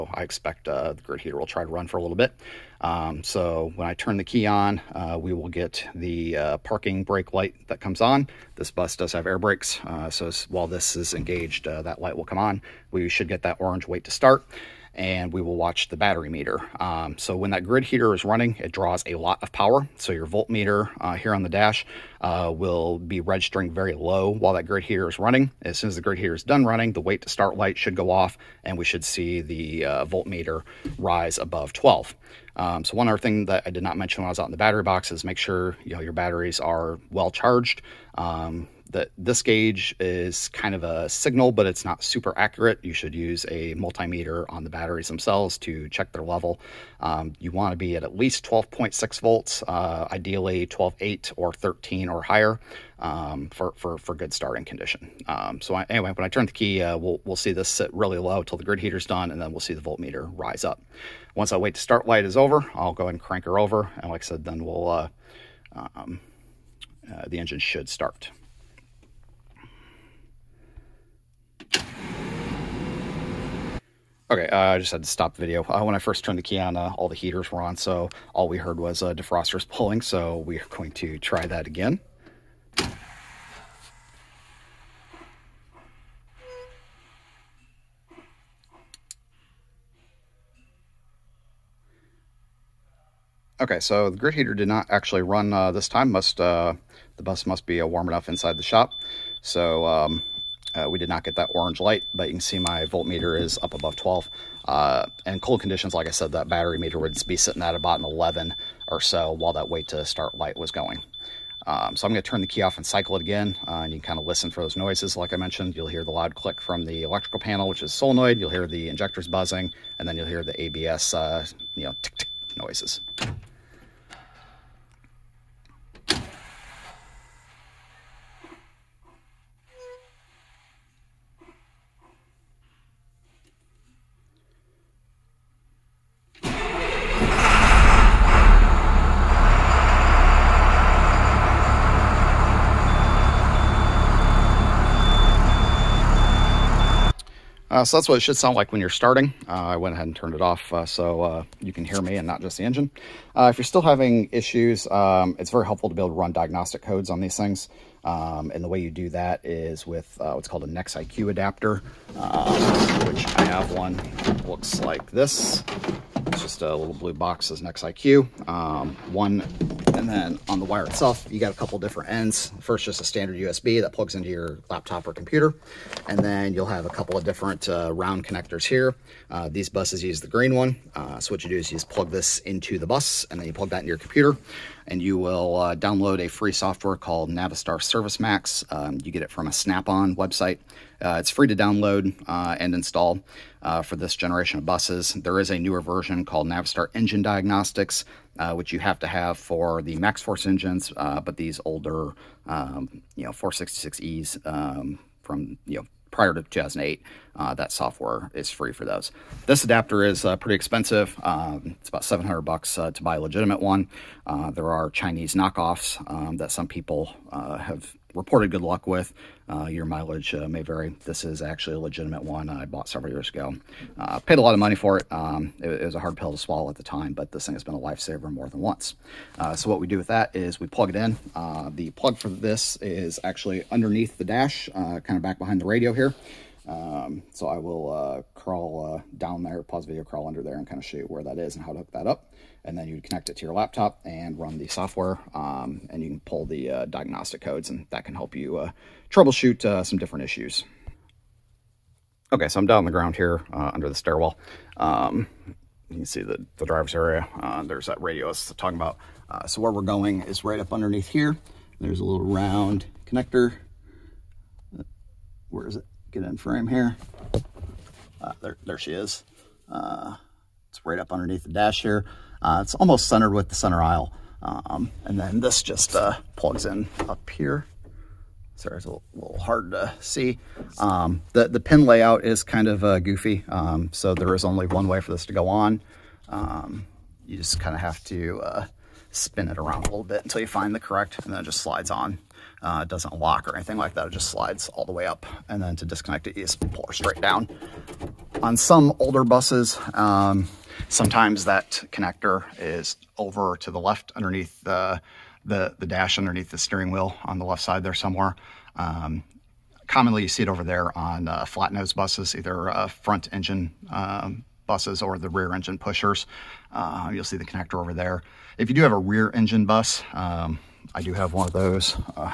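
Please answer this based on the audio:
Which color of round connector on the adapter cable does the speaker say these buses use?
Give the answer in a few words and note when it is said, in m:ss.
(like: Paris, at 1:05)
Green, at 3:00.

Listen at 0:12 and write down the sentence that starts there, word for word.
We should get that orange wait to start and we will watch the battery meter.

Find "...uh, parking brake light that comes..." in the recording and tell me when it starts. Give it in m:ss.
0:06.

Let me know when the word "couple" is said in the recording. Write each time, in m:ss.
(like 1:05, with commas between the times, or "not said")
2:51, 2:56.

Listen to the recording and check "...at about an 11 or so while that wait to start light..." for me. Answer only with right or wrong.
right.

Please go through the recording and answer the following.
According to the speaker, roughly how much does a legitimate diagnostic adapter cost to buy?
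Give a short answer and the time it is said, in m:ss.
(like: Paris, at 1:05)
$700, at 3:32.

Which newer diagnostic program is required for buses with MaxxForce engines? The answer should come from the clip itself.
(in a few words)
Navistar Engine Diagnostics.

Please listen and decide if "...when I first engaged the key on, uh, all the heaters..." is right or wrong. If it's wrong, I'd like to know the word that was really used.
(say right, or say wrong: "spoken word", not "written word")
wrong: "turned", not "engaged".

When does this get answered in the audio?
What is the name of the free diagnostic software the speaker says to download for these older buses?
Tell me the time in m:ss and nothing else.
3:07.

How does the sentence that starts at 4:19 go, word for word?
so where we're going is right up underneath here.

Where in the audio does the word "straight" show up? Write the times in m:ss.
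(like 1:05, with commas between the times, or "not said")
4:56.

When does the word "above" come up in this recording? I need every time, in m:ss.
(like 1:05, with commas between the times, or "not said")
0:31, 1:43.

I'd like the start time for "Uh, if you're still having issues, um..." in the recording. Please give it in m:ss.
2:33.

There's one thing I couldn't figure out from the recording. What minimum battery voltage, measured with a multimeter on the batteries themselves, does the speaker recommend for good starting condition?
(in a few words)
12.6 volts.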